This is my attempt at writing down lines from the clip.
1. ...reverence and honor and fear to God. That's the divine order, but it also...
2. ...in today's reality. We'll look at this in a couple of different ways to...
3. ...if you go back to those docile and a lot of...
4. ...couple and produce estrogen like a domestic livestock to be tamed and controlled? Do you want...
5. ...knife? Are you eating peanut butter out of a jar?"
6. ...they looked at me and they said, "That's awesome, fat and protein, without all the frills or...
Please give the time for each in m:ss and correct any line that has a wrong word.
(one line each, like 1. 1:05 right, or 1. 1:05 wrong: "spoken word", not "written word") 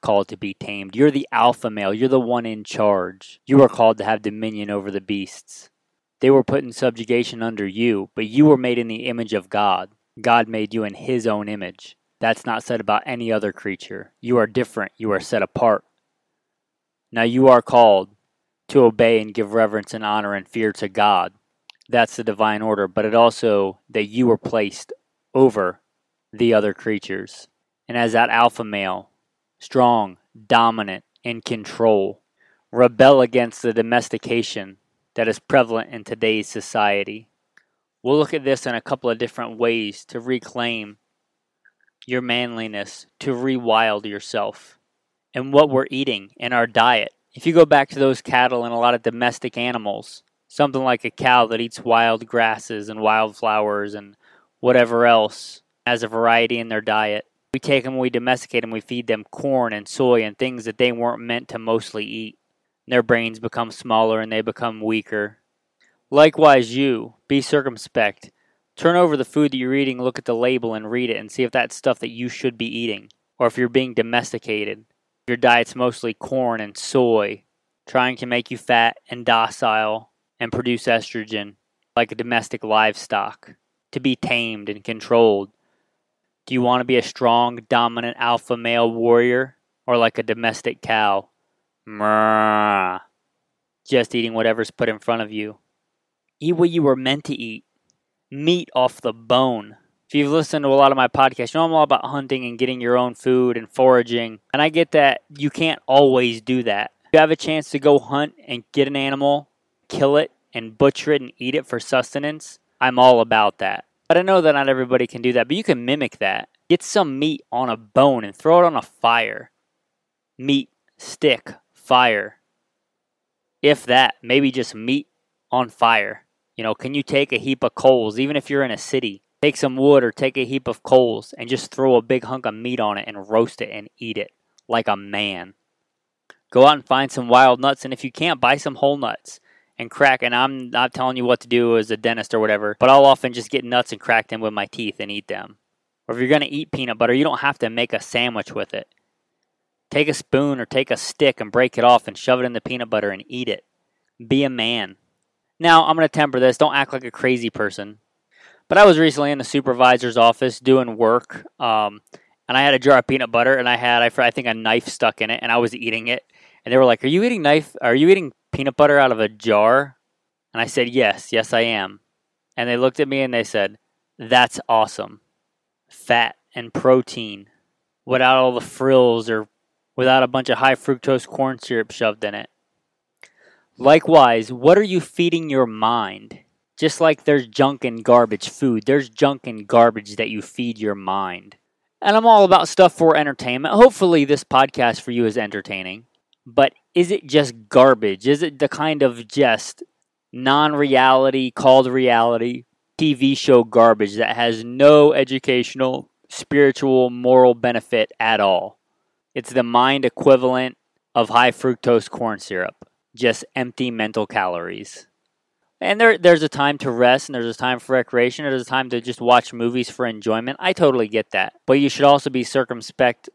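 1. 0:19 right
2. 0:35 wrong: "society", not "reality"
3. 0:47 wrong: "cattle", not "docile"
4. 1:19 wrong: "docile", not "couple"
5. 2:47 right
6. 2:52 right.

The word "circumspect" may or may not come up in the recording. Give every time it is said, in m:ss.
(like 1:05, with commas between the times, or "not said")
1:07, 3:42.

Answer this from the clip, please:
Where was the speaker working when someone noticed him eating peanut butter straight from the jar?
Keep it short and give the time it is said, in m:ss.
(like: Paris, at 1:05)
the supervisor's office, at 2:39.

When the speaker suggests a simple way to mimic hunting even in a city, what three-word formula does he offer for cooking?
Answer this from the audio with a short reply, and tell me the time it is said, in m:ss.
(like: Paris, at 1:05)
Meat, stick, fire, at 2:00.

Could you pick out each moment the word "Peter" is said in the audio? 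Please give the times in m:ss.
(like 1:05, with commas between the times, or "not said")
not said.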